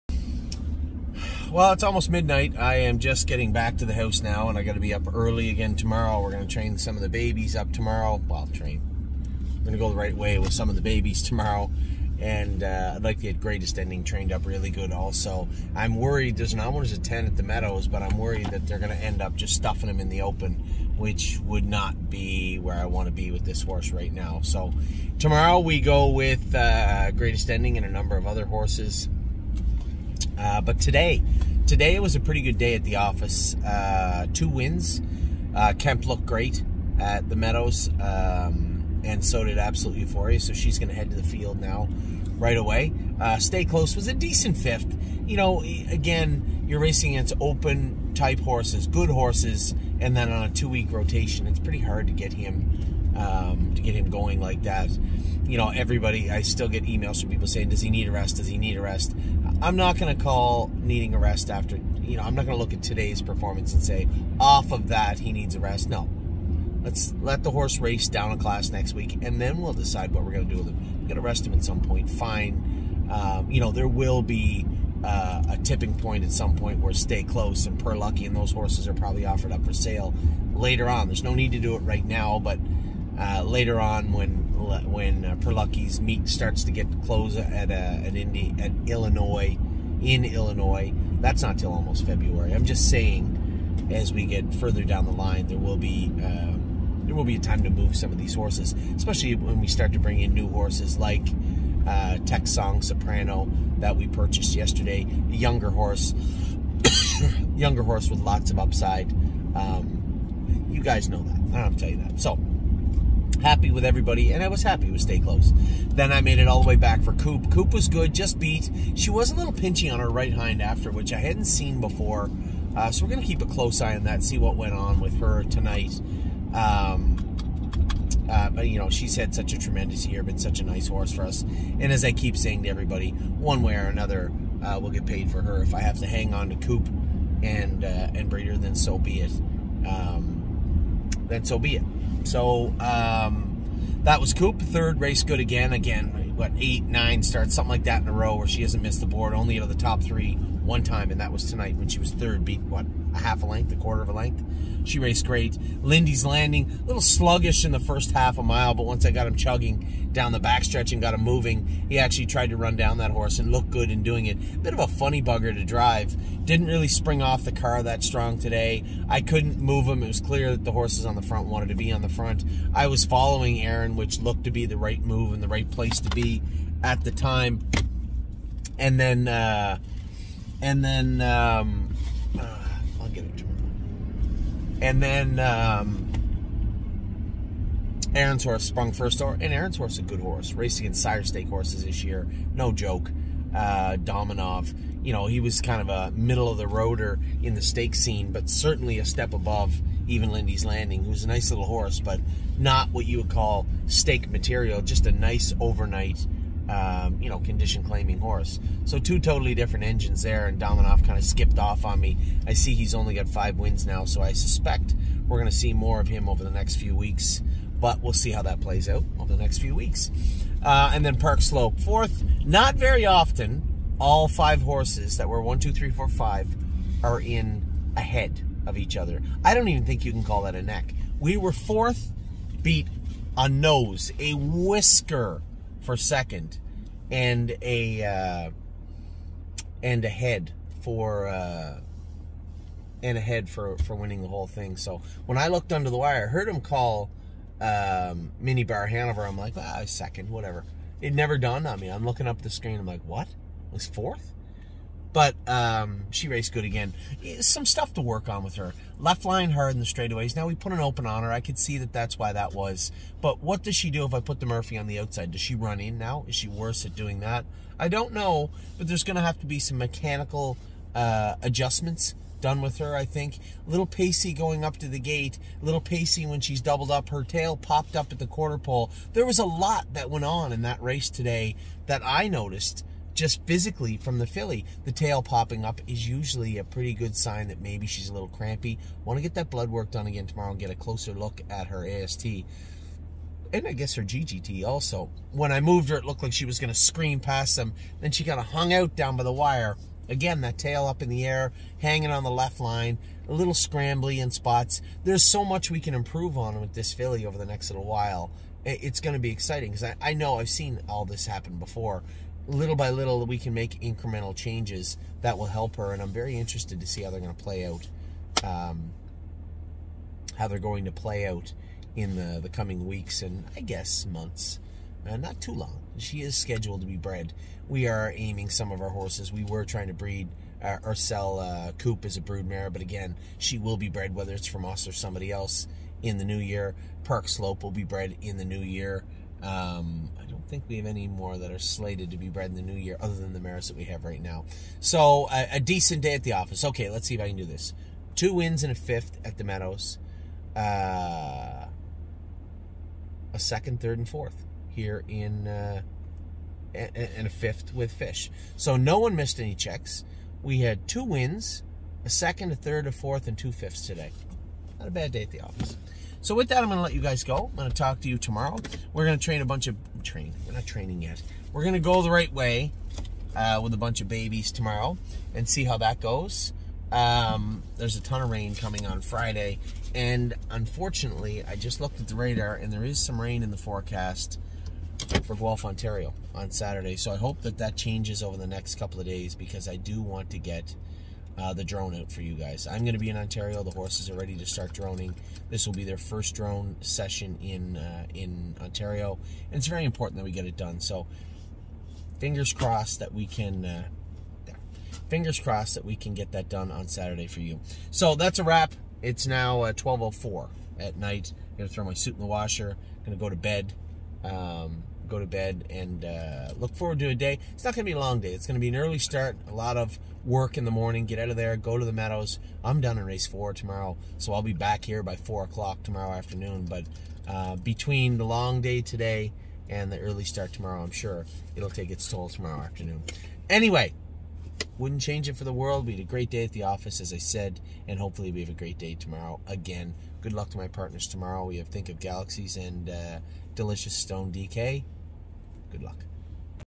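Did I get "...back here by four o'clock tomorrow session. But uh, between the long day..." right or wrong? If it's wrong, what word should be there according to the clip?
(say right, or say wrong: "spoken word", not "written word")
wrong: "afternoon", not "session".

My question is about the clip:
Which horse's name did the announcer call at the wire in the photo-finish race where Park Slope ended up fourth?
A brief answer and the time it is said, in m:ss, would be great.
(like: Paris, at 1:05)
Mini Bar Hanover, at 4:08.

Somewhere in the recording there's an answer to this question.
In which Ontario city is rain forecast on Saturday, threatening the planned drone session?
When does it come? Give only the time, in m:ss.
6:25.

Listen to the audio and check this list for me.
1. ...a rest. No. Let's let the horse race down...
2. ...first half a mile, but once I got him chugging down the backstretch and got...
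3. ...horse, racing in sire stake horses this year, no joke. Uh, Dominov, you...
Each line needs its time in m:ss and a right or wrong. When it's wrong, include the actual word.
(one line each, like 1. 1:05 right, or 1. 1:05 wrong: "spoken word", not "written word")
1. 1:05 right
2. 2:37 right
3. 3:10 right.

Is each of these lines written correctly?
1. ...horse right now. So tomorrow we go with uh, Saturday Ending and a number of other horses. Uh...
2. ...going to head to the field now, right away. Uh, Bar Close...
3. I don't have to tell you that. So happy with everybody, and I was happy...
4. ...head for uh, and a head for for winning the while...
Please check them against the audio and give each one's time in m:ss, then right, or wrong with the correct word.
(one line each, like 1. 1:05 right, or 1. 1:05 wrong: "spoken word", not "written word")
1. 0:23 wrong: "Greatest", not "Saturday"
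2. 0:40 wrong: "Stay", not "Bar"
3. 1:51 right
4. 4:00 wrong: "whole", not "while".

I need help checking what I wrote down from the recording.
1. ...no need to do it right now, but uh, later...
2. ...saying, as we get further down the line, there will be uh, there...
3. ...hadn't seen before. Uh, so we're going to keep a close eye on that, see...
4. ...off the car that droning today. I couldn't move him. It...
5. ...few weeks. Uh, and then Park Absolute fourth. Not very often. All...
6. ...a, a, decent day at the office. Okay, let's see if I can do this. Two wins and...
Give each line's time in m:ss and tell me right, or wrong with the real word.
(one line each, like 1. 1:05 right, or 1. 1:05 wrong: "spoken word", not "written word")
1. 1:21 right
2. 1:32 right
3. 2:01 right
4. 2:47 wrong: "strong", not "droning"
5. 3:39 wrong: "Slope", not "Absolute"
6. 5:45 right.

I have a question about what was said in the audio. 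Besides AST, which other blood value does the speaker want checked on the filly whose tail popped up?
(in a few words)
GGT.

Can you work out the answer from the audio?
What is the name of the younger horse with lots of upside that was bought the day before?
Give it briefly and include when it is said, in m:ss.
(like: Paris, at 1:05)
Song Soprano, at 1:42.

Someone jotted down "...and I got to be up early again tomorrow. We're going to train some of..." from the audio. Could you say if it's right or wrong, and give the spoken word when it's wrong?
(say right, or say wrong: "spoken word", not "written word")
right.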